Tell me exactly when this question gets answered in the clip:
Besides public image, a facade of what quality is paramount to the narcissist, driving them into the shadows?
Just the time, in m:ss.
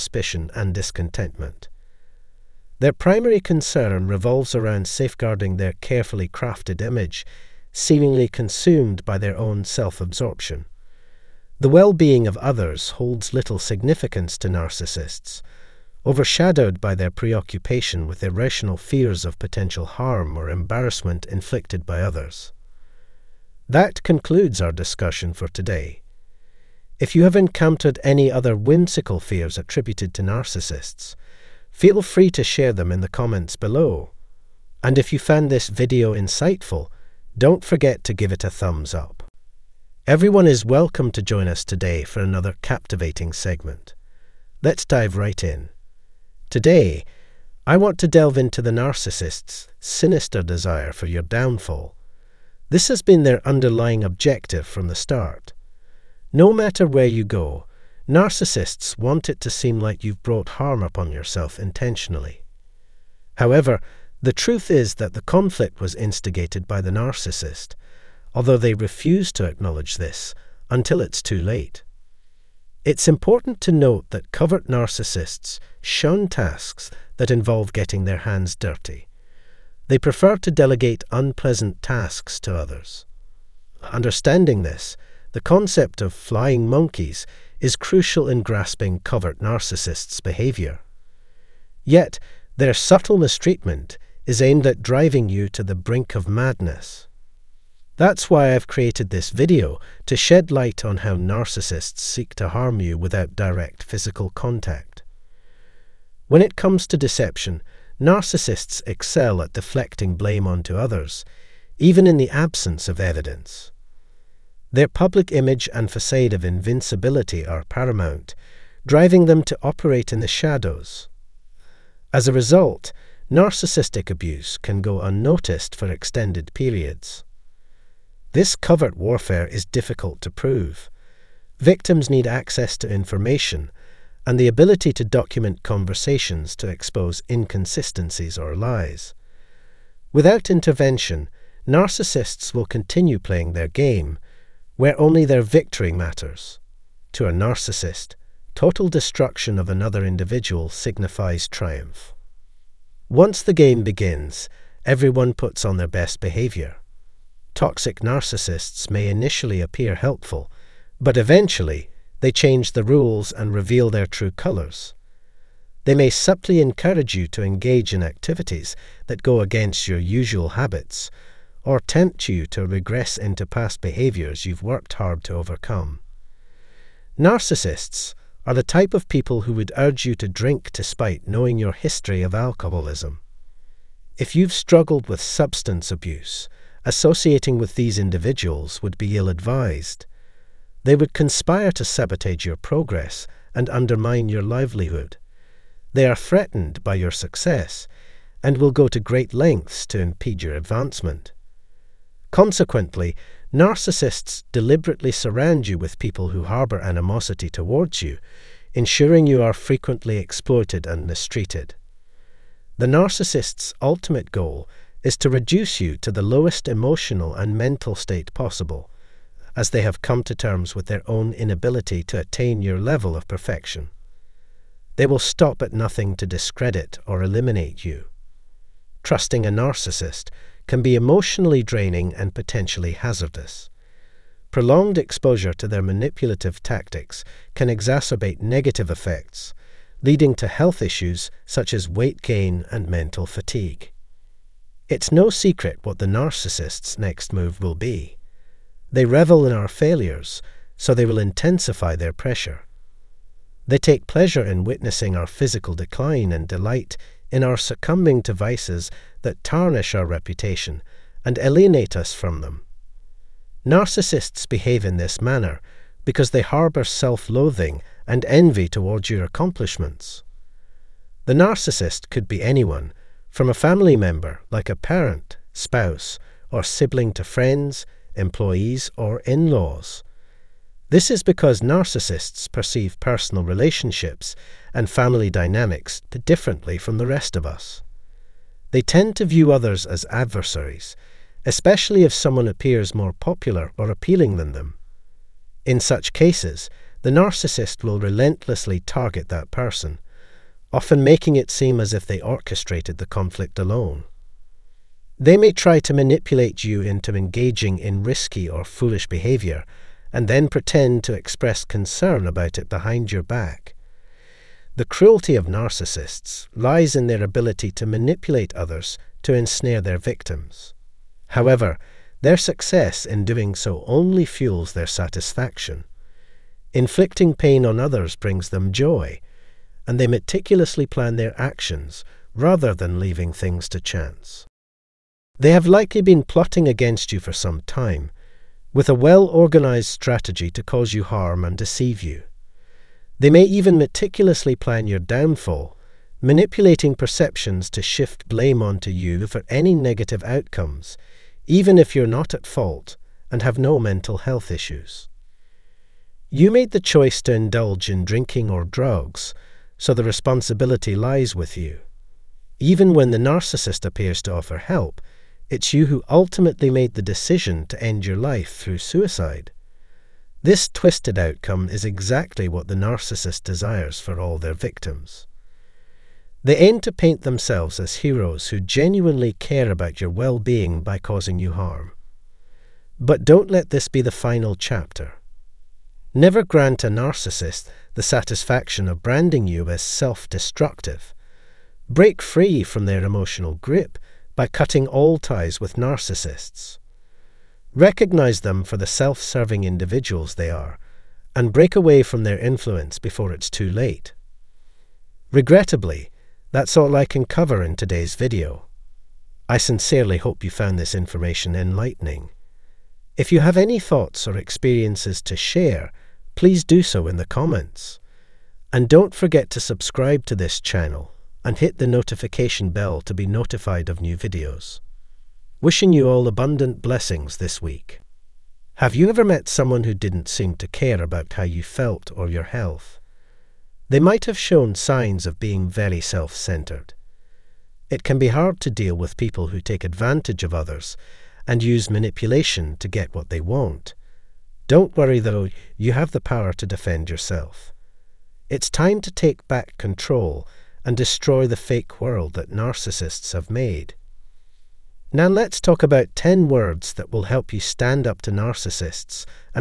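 1:56.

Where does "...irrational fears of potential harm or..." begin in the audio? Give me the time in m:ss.
0:18.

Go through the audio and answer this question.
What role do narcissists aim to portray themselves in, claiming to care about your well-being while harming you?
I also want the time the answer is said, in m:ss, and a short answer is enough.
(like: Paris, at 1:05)
heroes, at 6:17.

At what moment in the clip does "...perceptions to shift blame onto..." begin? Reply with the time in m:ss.
5:46.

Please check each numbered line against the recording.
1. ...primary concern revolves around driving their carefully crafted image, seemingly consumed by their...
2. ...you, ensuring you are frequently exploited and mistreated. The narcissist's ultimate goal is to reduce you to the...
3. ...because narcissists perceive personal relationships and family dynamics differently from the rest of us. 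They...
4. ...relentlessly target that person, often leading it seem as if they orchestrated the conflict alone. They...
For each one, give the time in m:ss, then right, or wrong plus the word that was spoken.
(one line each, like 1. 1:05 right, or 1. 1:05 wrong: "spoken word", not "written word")
1. 0:02 wrong: "safeguarding", not "driving"
2. 3:28 right
3. 4:41 right
4. 4:57 wrong: "making", not "leading".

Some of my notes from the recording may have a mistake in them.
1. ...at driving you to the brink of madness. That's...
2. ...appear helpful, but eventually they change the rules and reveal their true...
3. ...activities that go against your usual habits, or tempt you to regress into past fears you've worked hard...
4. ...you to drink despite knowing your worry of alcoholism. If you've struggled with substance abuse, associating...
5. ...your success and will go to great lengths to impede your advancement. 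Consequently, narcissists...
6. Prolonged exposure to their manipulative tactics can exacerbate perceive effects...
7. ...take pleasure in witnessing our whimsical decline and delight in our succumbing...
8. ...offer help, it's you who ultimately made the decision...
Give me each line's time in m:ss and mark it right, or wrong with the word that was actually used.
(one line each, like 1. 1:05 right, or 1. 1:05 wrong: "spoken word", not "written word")
1. 1:34 right
2. 2:39 right
3. 2:48 wrong: "behaviors", not "fears"
4. 3:00 wrong: "history", not "worry"
5. 3:16 right
6. 3:54 wrong: "negative", not "perceive"
7. 4:13 wrong: "physical", not "whimsical"
8. 6:04 right.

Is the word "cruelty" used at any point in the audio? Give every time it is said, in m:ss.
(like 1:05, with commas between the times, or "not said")
5:14.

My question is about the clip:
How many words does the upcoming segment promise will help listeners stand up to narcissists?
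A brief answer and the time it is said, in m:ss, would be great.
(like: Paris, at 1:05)
10, at 7:36.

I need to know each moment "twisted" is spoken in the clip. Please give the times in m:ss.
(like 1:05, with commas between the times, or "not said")
6:10.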